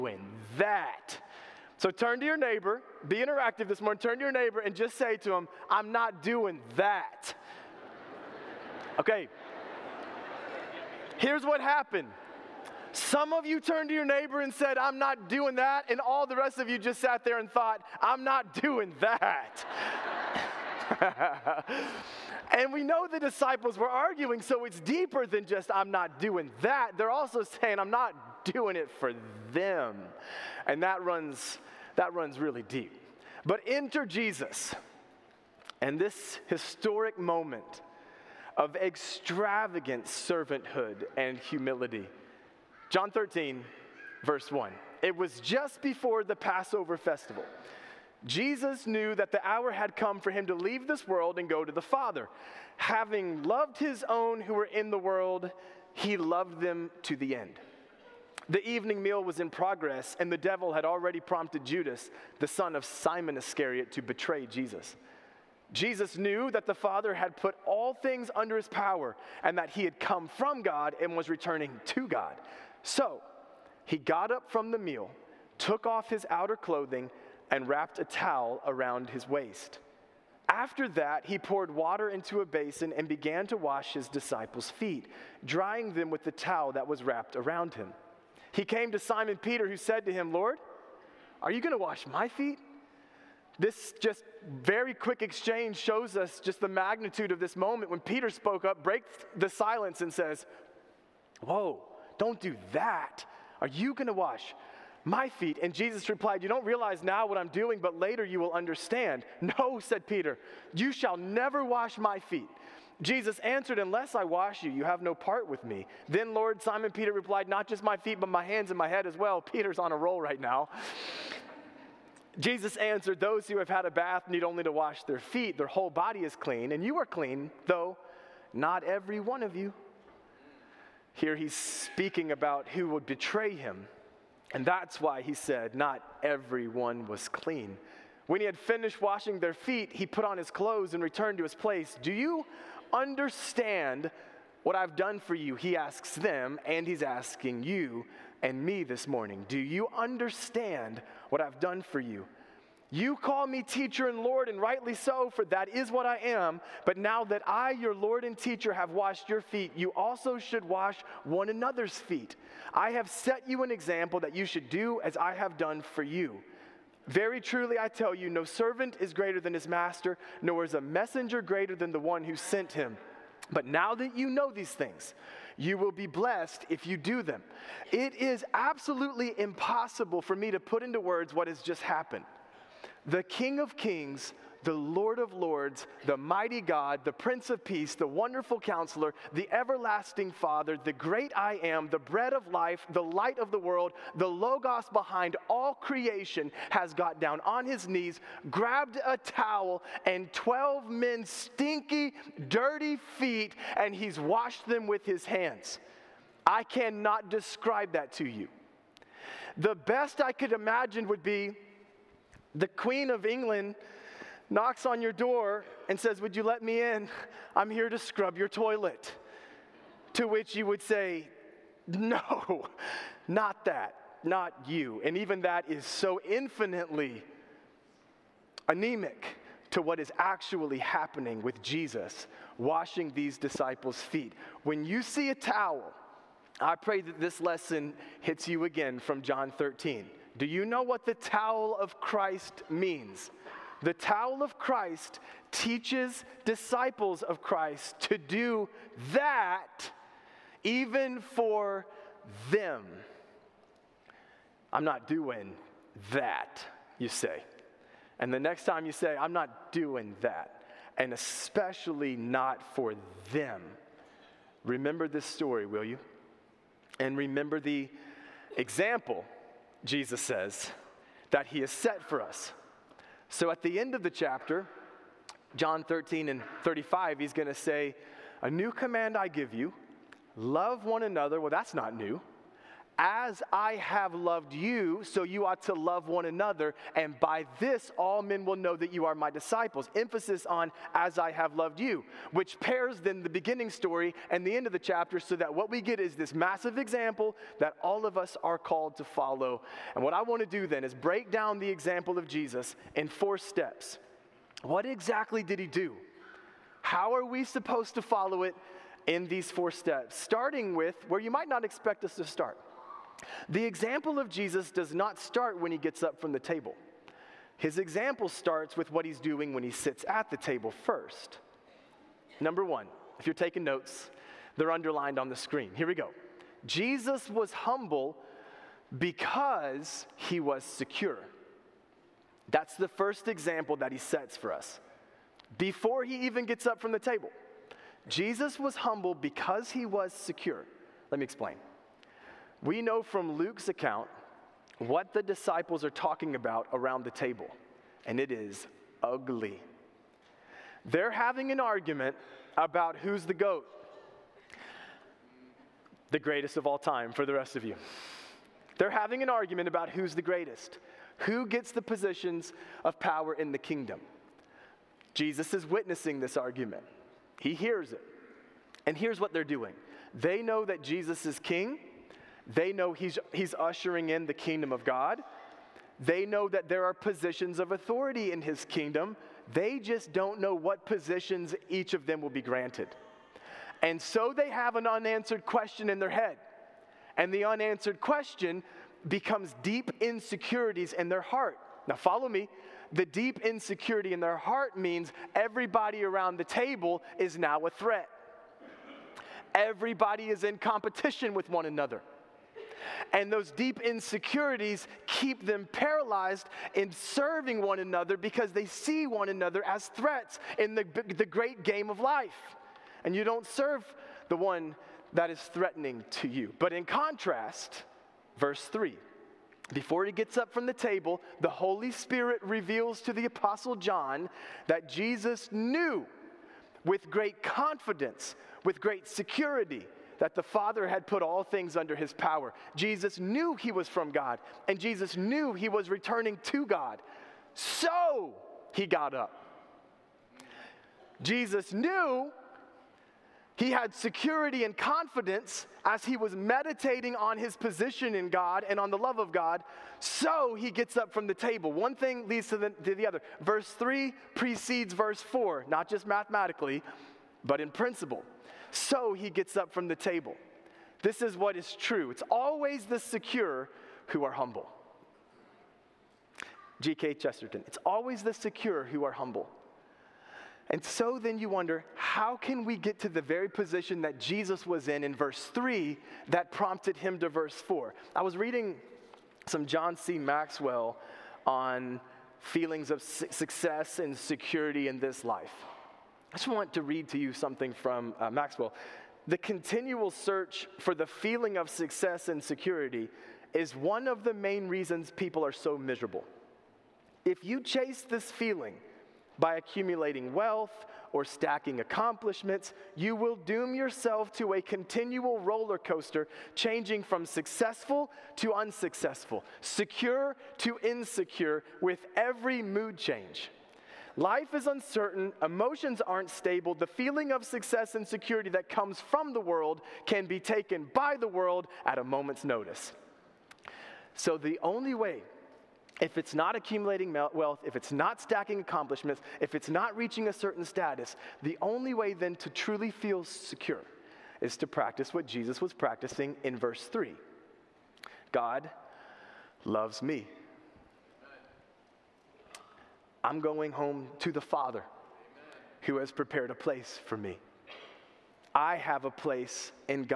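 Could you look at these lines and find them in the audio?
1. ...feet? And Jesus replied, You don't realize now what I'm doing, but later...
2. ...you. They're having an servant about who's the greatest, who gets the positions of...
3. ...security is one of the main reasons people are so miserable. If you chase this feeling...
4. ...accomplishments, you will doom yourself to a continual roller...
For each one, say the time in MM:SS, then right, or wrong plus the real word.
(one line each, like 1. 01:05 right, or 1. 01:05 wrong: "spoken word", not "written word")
1. 01:45 right
2. 05:57 wrong: "argument", not "servant"
3. 08:12 right
4. 08:21 right.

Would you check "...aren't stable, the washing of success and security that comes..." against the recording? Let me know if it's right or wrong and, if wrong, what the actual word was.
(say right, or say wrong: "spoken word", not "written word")
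wrong: "feeling", not "washing".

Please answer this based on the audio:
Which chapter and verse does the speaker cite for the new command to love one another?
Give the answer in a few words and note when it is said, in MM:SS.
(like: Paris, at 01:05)
John 13:35, at 04:35.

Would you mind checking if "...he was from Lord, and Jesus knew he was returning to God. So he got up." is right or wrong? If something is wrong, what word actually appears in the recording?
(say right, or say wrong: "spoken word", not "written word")
wrong: "God", not "Lord".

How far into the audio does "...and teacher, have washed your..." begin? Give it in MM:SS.
02:38.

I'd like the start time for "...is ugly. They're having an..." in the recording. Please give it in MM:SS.
05:48.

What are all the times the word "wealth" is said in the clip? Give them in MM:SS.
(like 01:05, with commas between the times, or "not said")
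08:20, 08:47.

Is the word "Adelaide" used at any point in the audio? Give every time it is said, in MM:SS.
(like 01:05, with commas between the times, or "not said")
not said.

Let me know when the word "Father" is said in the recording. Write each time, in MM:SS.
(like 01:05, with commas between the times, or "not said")
00:51, 01:06, 03:10, 07:10, 09:04.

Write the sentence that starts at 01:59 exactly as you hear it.
Peter's on a roll right now.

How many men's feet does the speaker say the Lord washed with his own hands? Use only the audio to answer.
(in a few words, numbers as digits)
12.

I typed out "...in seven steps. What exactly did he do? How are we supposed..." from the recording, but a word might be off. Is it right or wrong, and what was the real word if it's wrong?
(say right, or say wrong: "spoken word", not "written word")
wrong: "four", not "seven".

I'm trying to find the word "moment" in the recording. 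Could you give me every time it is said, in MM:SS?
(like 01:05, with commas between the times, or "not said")
00:37, 01:37, 08:42.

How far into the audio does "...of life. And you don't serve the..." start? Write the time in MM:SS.
06:51.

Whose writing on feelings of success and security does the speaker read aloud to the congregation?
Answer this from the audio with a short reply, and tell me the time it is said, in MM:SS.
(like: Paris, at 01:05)
John C. Maxwell, at 07:59.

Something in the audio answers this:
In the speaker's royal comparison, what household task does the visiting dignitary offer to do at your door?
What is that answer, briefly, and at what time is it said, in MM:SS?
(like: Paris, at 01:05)
scrub your toilet, at 03:37.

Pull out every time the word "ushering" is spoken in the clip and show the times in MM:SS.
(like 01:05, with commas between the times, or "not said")
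06:13.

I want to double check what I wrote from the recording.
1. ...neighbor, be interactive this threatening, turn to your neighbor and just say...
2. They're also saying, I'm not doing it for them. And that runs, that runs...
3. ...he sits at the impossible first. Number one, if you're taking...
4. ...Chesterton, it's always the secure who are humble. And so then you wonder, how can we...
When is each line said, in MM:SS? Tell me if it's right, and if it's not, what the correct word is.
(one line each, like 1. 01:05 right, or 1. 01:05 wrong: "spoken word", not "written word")
1. 00:02 wrong: "morning", not "threatening"
2. 00:26 right
3. 05:19 wrong: "table", not "impossible"
4. 07:47 right.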